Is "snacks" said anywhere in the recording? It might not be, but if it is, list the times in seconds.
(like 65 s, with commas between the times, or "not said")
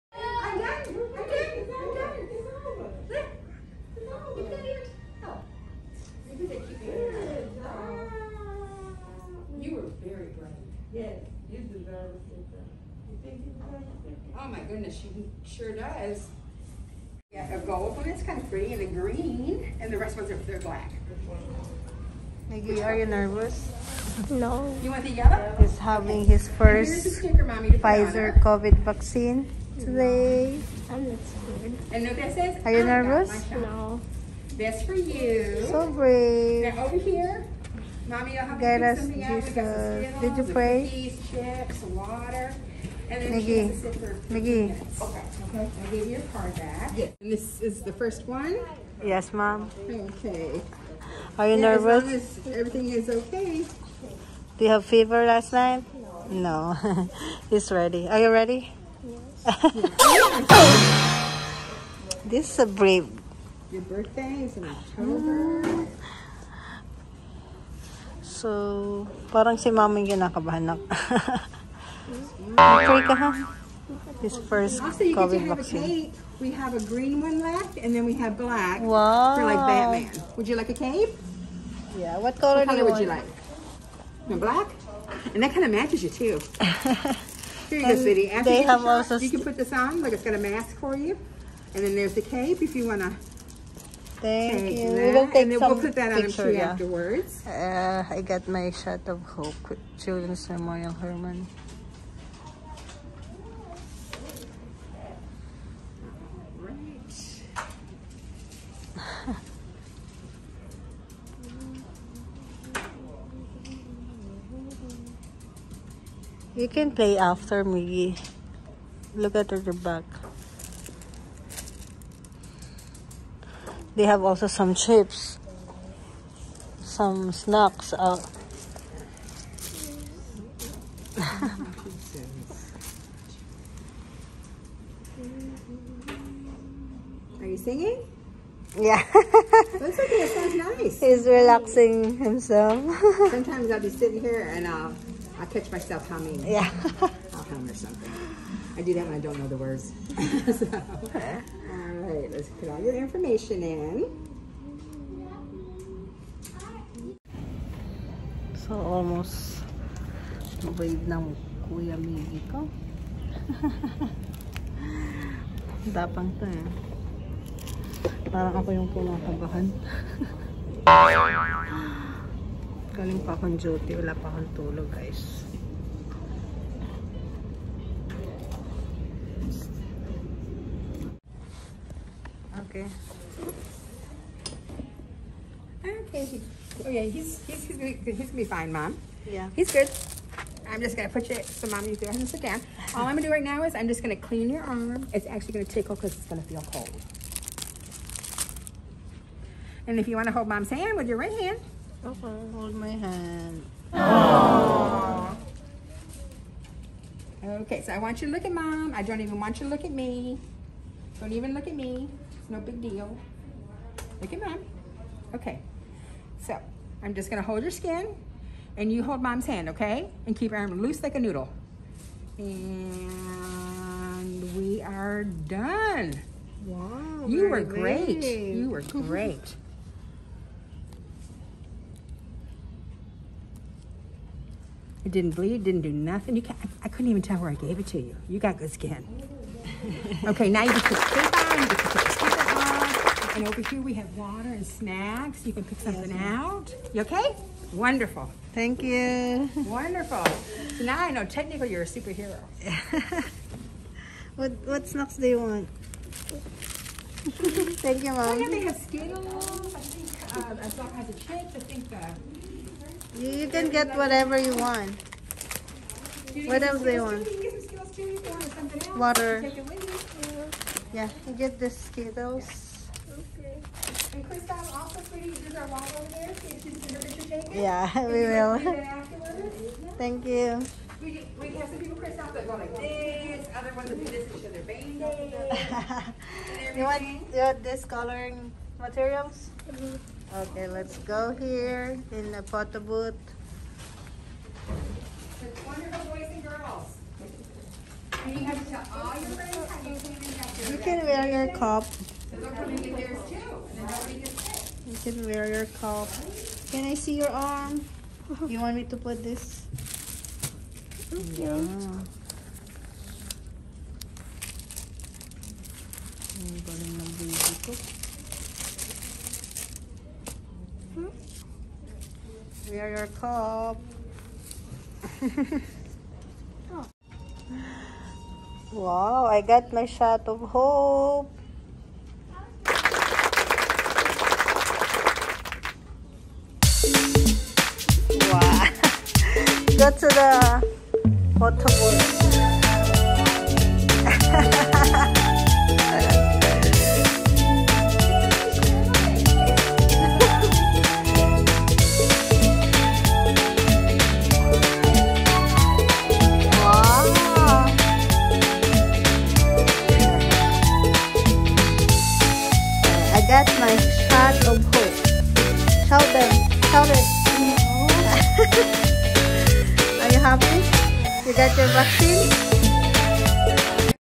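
127 s, 244 s, 254 s.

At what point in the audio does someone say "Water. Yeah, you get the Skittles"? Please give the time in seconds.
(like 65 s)
268 s.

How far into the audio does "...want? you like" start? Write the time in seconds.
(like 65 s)
82 s.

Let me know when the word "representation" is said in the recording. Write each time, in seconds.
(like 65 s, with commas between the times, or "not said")
not said.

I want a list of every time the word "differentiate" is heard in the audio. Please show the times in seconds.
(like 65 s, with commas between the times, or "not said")
not said.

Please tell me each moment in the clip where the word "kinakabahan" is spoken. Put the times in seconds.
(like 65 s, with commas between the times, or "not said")
70 s, 168 s.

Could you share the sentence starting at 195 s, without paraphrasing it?
It's actually gonna tickle because it's gonna feel cold.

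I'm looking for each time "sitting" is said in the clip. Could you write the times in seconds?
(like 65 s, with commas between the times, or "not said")
143 s.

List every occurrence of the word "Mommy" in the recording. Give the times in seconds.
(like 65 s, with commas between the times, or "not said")
27 s, 38 s.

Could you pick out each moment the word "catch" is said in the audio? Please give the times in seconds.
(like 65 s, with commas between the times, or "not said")
145 s.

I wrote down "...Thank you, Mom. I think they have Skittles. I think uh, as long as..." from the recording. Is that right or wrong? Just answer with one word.
right.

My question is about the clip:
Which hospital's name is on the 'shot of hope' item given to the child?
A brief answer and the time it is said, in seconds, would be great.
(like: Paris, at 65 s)
Children's Memorial Hermann, at 99 s.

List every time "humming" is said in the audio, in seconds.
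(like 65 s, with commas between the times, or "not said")
146 s.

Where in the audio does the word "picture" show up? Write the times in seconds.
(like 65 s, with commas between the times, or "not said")
96 s, 276 s.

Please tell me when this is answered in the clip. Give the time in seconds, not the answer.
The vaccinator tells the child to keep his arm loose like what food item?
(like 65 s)
221 s.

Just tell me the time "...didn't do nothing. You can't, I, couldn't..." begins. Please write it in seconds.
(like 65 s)
235 s.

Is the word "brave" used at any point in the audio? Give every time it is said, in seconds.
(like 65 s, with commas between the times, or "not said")
35 s, 62 s.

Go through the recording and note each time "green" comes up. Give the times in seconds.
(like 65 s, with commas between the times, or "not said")
18 s, 76 s.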